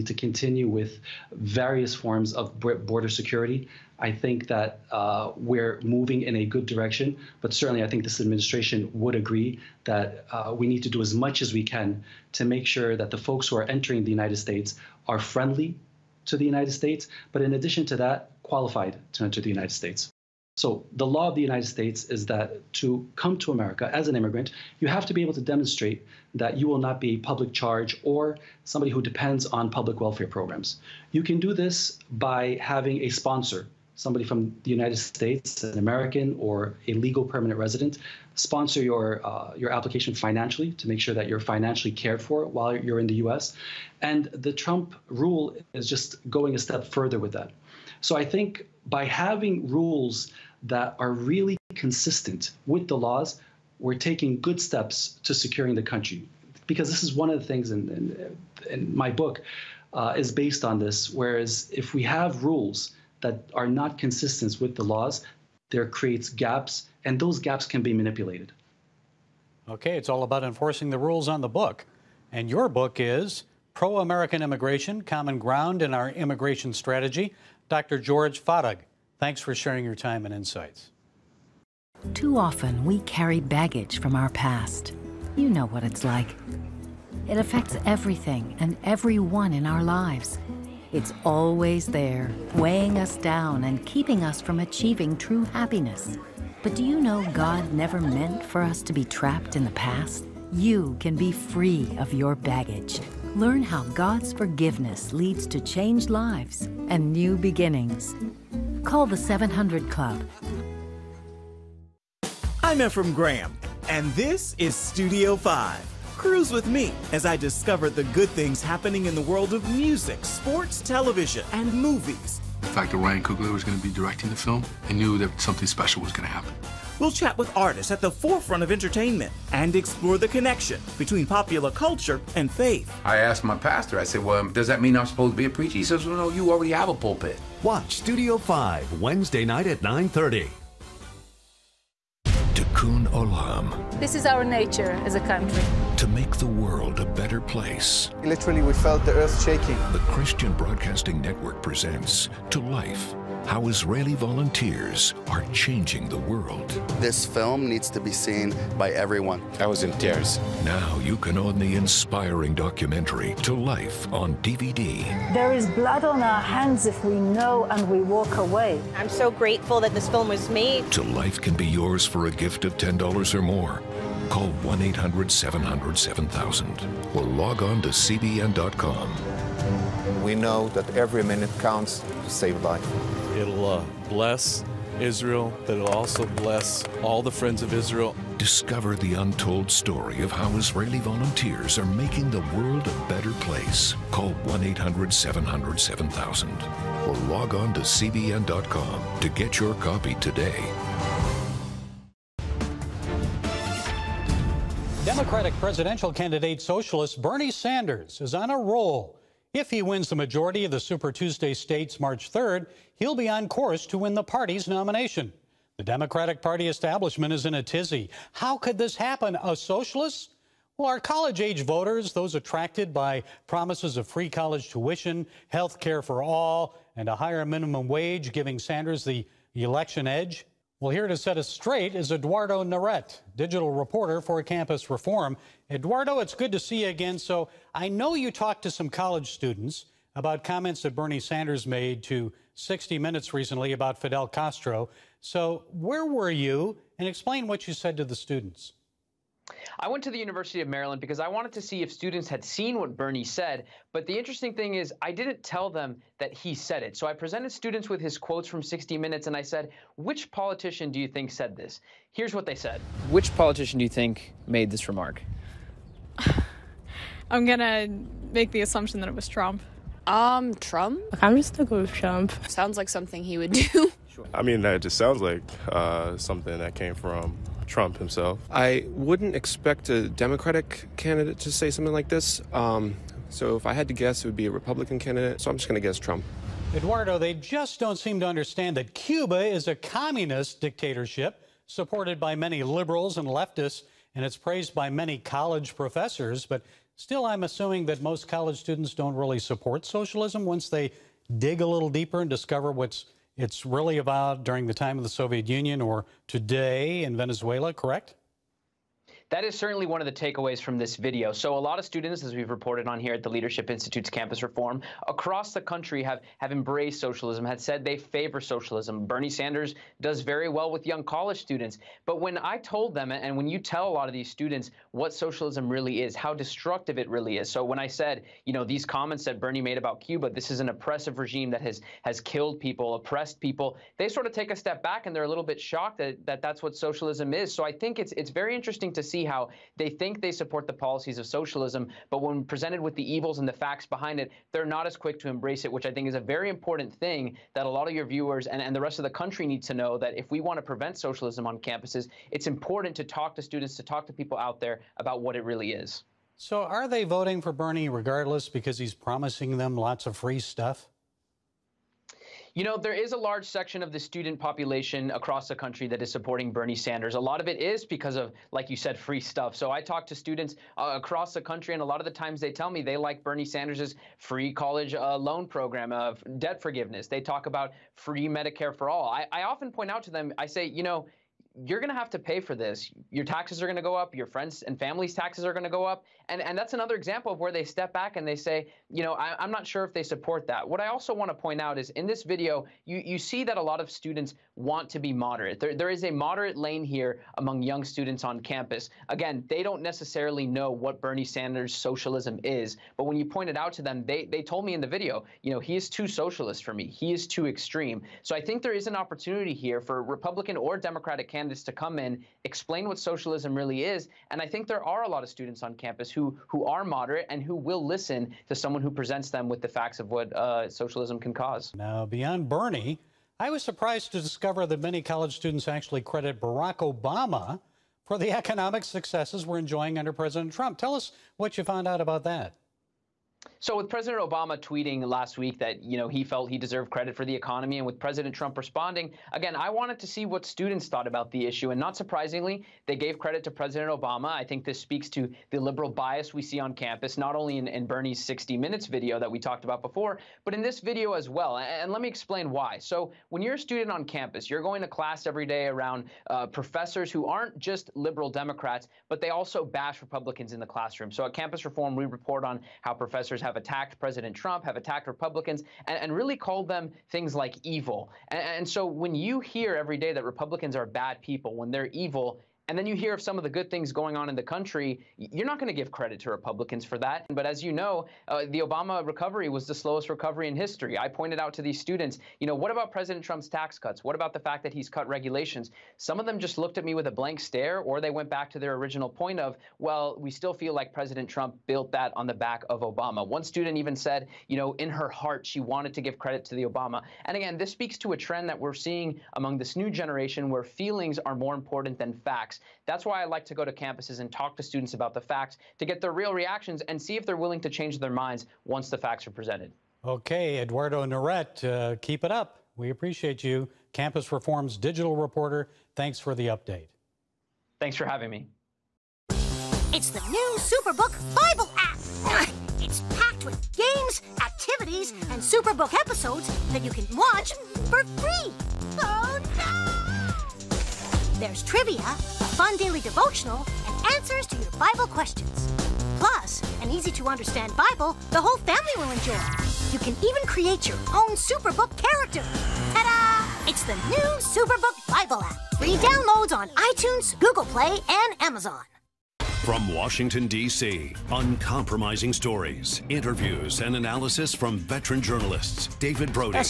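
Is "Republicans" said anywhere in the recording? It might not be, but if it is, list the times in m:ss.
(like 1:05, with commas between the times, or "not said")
4:44, 6:50, 7:39, 7:45, 7:50, 7:56.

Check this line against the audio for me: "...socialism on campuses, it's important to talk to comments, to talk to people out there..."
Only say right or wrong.
wrong.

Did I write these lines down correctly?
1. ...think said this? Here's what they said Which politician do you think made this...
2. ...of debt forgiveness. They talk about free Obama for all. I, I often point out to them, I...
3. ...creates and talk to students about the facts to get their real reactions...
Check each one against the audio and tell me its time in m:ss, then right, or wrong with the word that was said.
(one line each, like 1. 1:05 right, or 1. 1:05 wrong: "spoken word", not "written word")
1. 4:21 right
2. 6:15 wrong: "Medicare", not "Obama"
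3. 8:23 wrong: "campuses", not "creates".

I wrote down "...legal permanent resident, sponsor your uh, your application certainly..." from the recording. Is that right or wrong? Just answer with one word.
wrong.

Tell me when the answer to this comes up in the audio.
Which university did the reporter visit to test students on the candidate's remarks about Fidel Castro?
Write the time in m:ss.
4:10.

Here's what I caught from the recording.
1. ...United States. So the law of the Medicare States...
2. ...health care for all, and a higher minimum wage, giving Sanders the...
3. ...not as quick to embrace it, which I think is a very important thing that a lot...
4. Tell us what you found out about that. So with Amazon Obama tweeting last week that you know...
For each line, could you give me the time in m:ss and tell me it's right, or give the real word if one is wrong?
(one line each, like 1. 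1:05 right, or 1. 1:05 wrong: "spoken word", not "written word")
1. 0:19 wrong: "United", not "Medicare"
2. 3:45 right
3. 5:44 right
4. 7:10 wrong: "President", not "Amazon".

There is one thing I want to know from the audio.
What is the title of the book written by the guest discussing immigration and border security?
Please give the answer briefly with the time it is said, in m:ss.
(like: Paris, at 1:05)
Pro American Immigration, at 1:13.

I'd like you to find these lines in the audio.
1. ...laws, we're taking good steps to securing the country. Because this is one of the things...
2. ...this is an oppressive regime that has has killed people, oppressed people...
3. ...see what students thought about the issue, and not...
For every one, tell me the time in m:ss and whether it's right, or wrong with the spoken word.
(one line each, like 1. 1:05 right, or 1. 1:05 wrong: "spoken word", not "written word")
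1. 0:52 right
2. 5:30 right
3. 7:20 right.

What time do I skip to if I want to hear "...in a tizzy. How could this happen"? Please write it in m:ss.
3:37.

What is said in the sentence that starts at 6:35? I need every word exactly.
There, there is a moderate lane here among young students on campus.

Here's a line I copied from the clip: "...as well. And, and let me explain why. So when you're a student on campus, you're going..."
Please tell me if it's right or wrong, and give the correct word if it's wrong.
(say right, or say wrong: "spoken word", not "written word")
right.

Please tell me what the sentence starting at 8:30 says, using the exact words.
Okay, Eduardo Neret, uh, keep it up.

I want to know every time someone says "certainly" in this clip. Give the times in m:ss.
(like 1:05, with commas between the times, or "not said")
0:07, 5:09.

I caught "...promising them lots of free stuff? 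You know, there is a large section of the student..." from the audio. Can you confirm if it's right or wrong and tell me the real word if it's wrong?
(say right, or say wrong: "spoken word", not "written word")
right.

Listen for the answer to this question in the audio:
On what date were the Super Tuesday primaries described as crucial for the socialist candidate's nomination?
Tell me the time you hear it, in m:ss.
3:31.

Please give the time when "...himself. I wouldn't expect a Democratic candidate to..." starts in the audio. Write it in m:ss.
4:37.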